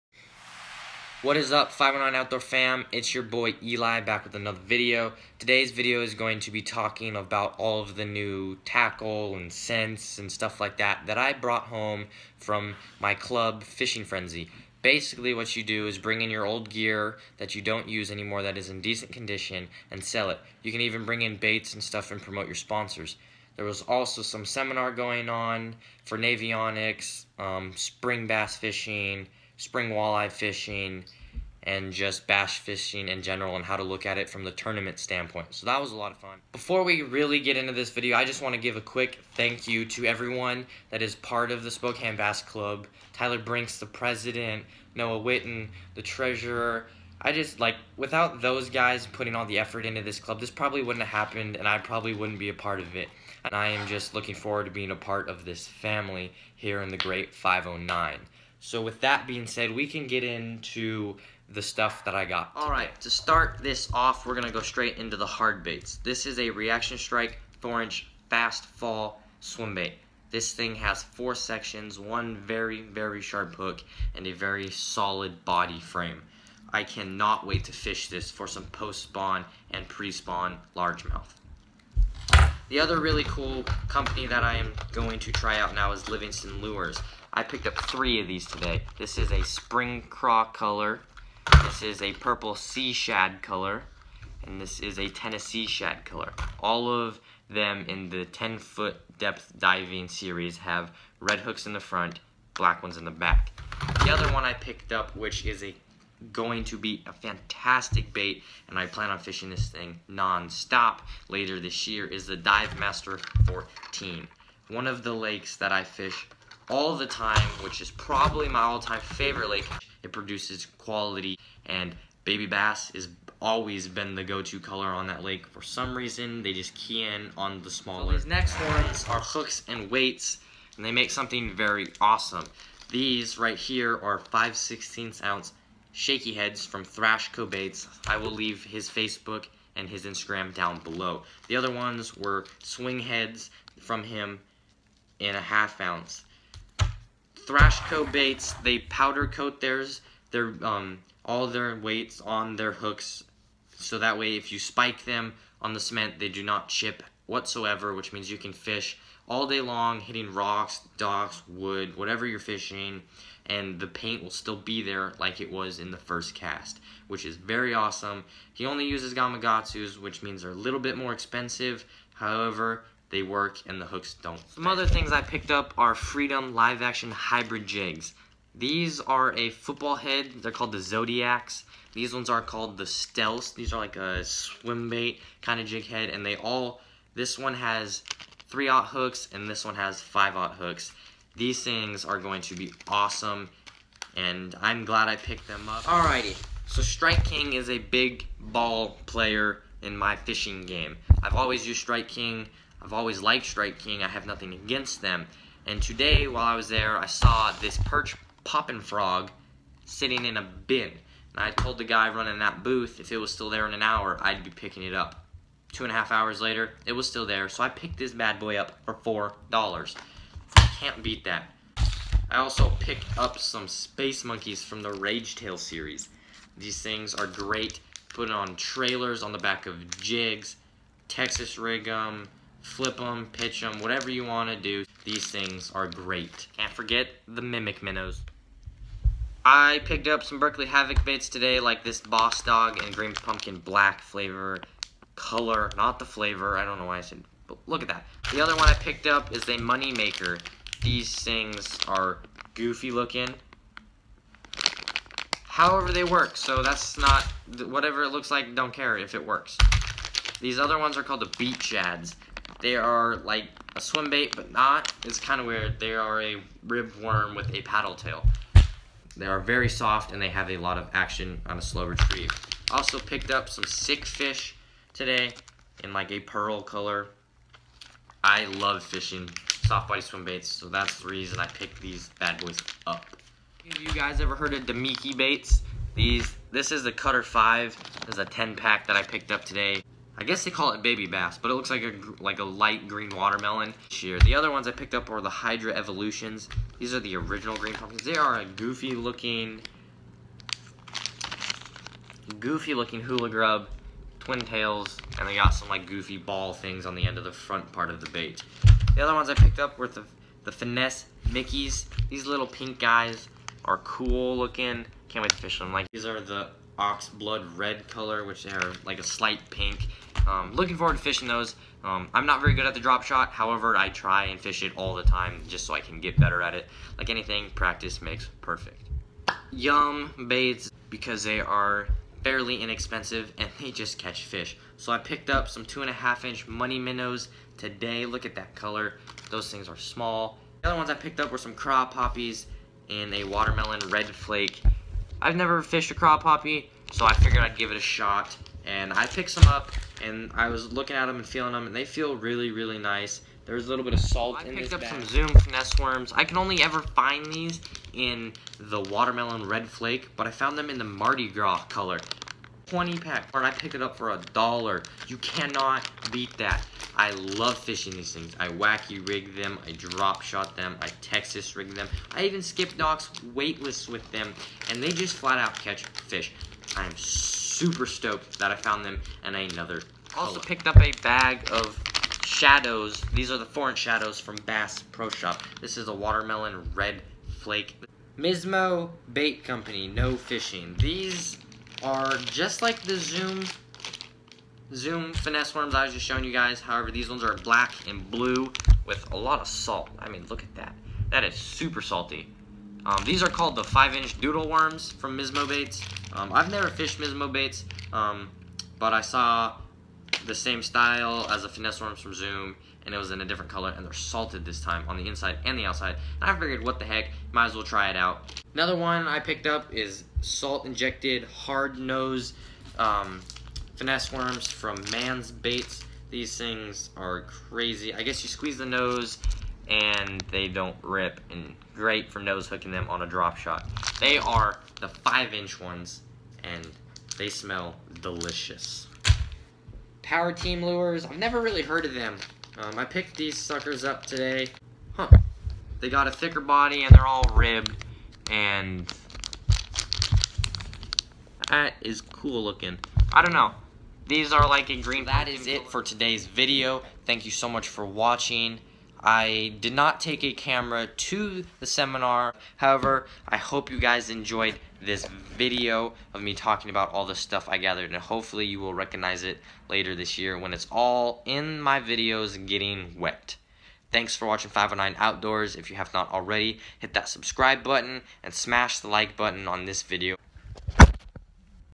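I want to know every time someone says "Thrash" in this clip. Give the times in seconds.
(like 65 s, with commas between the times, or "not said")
136 s, 147 s.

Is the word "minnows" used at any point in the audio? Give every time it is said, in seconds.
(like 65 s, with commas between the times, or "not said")
237 s, 336 s.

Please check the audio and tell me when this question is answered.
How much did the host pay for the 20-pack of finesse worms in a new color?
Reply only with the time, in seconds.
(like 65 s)
364 s.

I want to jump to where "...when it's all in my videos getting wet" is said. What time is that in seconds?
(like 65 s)
470 s.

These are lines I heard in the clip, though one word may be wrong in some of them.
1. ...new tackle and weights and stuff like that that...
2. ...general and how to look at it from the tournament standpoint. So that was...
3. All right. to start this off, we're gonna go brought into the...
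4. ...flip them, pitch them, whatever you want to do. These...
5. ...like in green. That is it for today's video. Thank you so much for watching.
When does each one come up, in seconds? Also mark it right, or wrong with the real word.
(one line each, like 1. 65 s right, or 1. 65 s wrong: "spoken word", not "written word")
1. 8 s wrong: "scents", not "weights"
2. 33 s right
3. 62 s wrong: "straight", not "brought"
4. 232 s right
5. 454 s right.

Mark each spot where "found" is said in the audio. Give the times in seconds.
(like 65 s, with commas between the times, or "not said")
360 s, 378 s.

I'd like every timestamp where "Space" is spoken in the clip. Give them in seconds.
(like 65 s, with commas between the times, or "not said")
223 s.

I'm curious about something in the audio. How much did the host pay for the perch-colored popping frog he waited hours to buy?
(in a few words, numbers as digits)
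$4.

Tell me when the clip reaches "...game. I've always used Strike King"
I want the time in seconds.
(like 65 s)
200 s.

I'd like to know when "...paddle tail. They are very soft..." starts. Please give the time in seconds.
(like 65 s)
267 s.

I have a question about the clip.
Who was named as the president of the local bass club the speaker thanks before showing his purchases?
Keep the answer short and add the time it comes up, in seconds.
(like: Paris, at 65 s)
Tyler Brinks, at 43 s.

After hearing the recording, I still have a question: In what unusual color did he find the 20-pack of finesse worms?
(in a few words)
Mardi Gras.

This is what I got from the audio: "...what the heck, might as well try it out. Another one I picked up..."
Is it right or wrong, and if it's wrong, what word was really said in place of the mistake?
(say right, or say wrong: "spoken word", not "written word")
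right.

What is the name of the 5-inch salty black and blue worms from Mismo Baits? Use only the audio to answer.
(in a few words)
doodle worms.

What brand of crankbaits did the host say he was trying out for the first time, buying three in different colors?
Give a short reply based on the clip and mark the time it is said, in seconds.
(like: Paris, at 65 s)
Livingston Lures, at 86 s.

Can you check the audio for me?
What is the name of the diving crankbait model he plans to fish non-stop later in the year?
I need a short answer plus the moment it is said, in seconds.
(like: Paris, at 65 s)
Dive Master 14, at 112 s.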